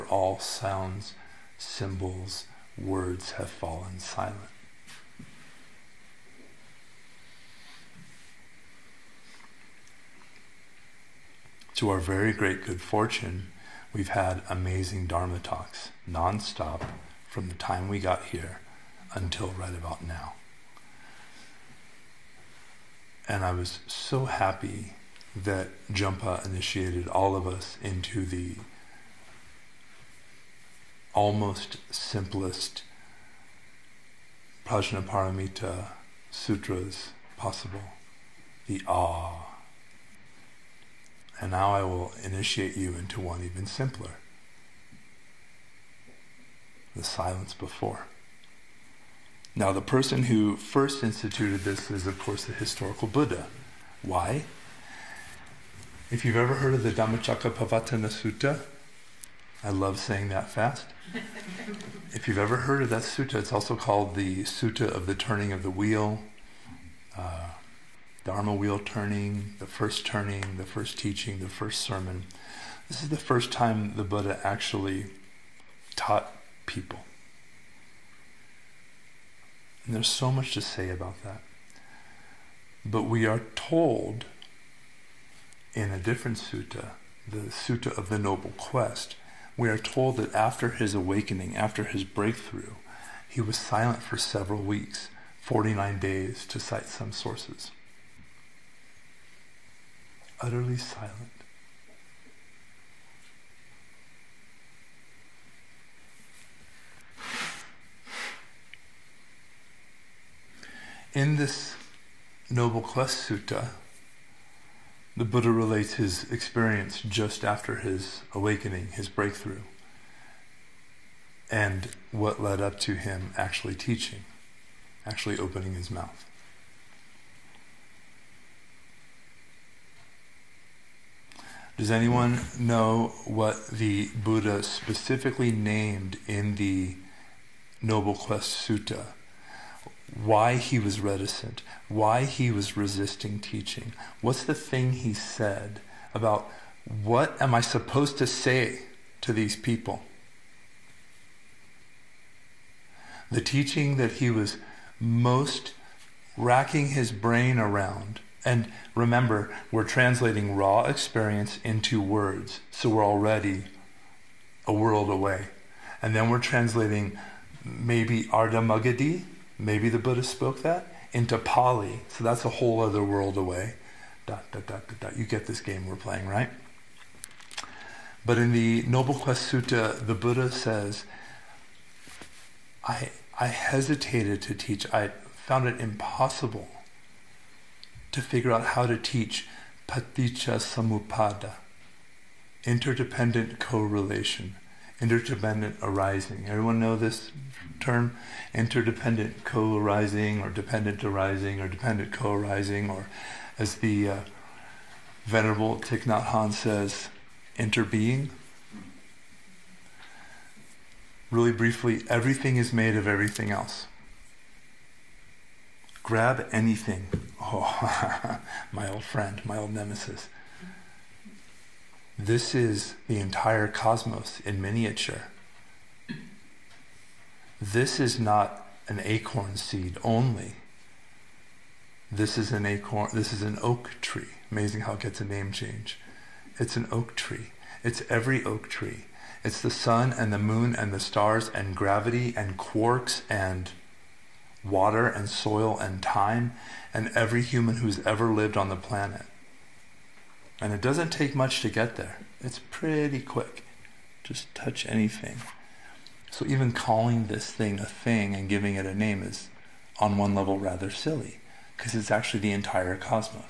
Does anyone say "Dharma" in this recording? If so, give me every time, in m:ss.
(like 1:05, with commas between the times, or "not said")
0:15, 1:08.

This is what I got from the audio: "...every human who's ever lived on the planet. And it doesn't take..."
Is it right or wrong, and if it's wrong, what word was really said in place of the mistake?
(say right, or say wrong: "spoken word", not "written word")
right.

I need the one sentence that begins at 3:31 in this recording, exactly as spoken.
Really briefly, everything is made of everything else.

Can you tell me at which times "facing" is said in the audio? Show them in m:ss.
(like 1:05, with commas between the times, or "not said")
not said.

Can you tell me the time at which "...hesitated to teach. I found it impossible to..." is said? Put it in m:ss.
3:03.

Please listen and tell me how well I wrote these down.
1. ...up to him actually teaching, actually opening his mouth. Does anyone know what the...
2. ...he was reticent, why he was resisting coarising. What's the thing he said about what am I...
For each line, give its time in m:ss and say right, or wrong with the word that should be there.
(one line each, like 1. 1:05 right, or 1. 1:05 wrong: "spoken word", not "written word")
1. 2:02 right
2. 2:20 wrong: "teaching", not "coarising".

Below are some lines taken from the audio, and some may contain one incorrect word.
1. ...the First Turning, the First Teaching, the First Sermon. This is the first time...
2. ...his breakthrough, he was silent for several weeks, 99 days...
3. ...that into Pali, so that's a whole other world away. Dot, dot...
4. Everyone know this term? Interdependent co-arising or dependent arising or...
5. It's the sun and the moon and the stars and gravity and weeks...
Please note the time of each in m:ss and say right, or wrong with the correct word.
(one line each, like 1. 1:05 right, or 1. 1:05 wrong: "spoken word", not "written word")
1. 1:09 right
2. 1:31 wrong: "49", not "99"
3. 2:50 right
4. 3:16 right
5. 3:59 wrong: "quarks", not "weeks".